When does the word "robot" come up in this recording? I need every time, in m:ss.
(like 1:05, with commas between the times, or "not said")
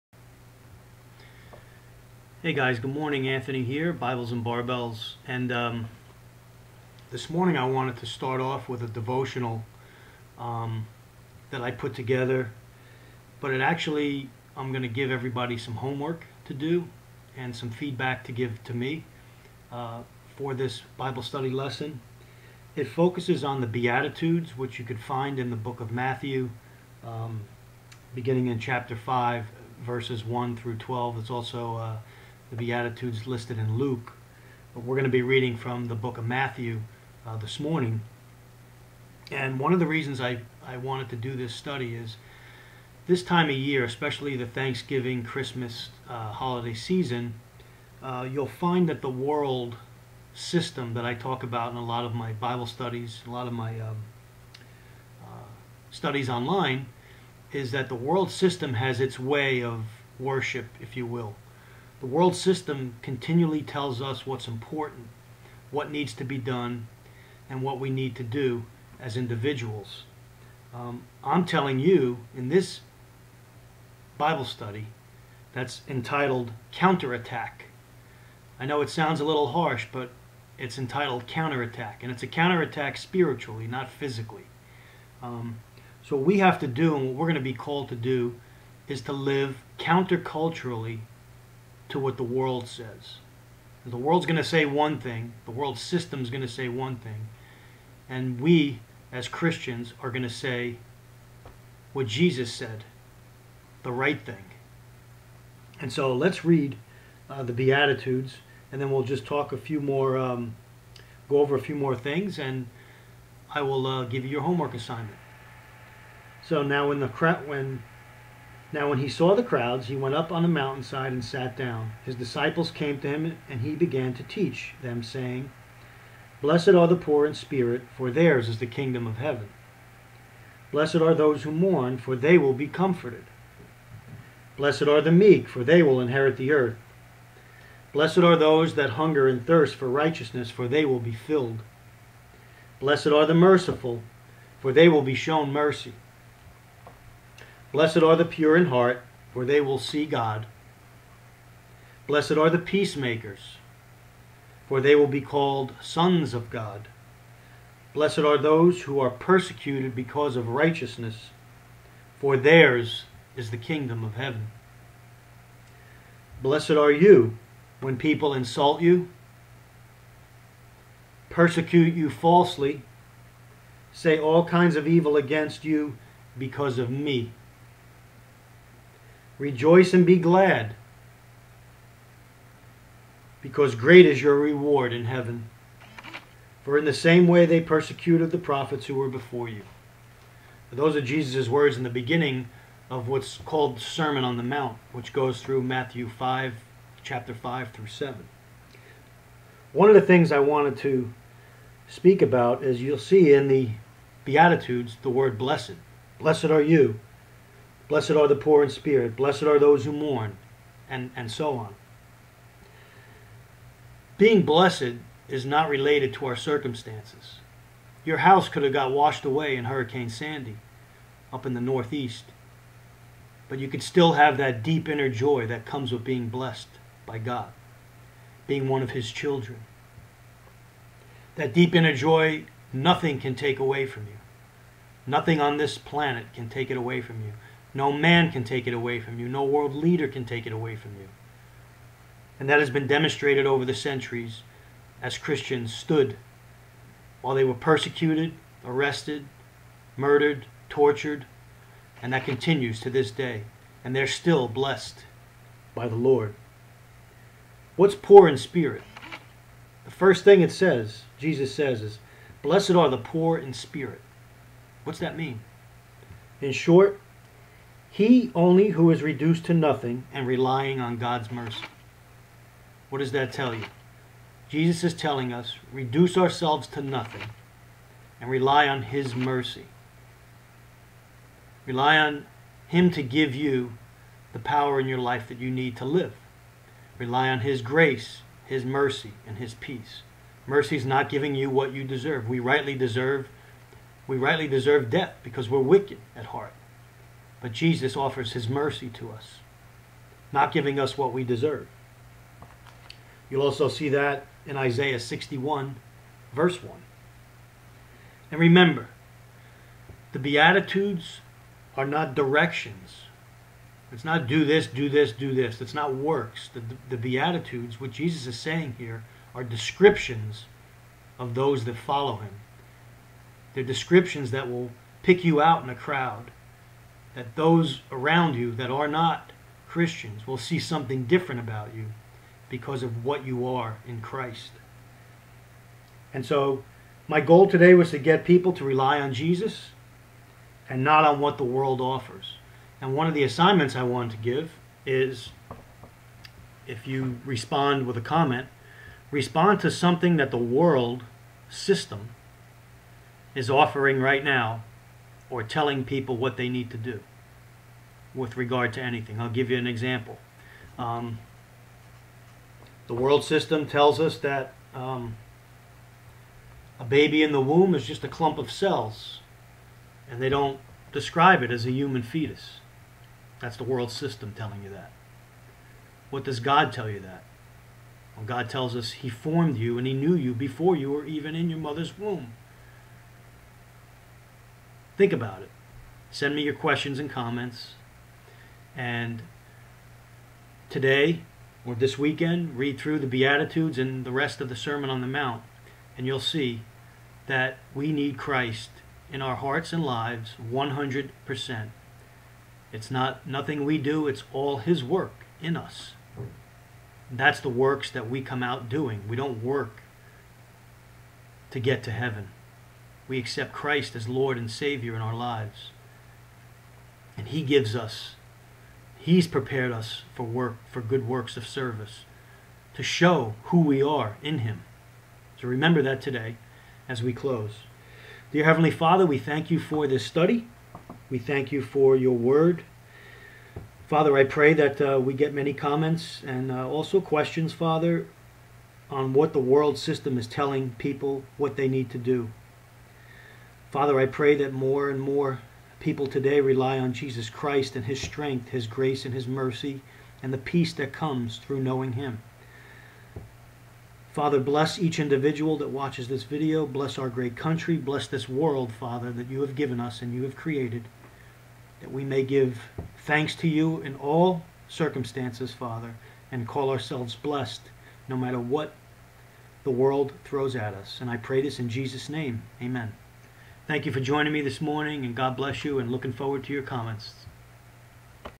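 not said.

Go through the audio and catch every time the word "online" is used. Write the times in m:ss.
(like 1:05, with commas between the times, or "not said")
0:56.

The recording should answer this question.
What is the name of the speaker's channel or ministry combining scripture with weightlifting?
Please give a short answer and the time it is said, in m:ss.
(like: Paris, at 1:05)
Bibles and Barbells, at 0:03.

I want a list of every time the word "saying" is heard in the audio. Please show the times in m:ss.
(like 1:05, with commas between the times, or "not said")
2:05, 5:18.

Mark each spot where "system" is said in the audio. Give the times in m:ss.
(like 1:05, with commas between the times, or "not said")
0:50, 0:58, 1:02, 1:35, 5:51, 6:03, 6:13, 7:19.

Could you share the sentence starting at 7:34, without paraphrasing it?
Father, bless each individual that watches this video.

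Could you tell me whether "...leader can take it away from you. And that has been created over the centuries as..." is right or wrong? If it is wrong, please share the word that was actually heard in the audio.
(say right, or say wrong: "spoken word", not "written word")
wrong: "demonstrated", not "created".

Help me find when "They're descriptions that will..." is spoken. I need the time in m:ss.
5:23.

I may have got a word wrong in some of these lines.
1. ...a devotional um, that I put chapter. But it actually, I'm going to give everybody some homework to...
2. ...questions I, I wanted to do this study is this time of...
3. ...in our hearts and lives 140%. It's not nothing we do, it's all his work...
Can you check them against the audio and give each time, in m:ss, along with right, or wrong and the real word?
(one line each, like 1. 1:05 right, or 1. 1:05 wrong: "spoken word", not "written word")
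1. 0:08 wrong: "together", not "chapter"
2. 0:39 wrong: "reasons", not "questions"
3. 6:39 wrong: "100", not "140".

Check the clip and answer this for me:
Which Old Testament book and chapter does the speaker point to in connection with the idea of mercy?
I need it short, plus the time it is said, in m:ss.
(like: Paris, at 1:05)
Isaiah 61, at 5:04.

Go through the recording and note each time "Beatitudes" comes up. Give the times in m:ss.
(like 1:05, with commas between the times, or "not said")
0:23, 0:32, 1:47, 3:24, 5:10, 5:16, 6:33.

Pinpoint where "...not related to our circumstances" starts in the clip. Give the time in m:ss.
3:35.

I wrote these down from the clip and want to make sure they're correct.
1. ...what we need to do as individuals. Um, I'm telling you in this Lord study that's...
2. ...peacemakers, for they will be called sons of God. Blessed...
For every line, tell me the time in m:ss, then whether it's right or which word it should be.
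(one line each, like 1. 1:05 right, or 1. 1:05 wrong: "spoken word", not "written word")
1. 1:07 wrong: "Bible", not "Lord"
2. 2:32 right.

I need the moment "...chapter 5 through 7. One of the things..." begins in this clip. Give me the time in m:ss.
3:17.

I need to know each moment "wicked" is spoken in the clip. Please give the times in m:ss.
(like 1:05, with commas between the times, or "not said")
4:55.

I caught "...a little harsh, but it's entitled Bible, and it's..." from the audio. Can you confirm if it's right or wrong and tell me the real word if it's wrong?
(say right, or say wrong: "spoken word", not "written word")
wrong: "Counterattack", not "Bible".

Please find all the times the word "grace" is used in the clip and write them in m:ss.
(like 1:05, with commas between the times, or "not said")
4:47, 7:28.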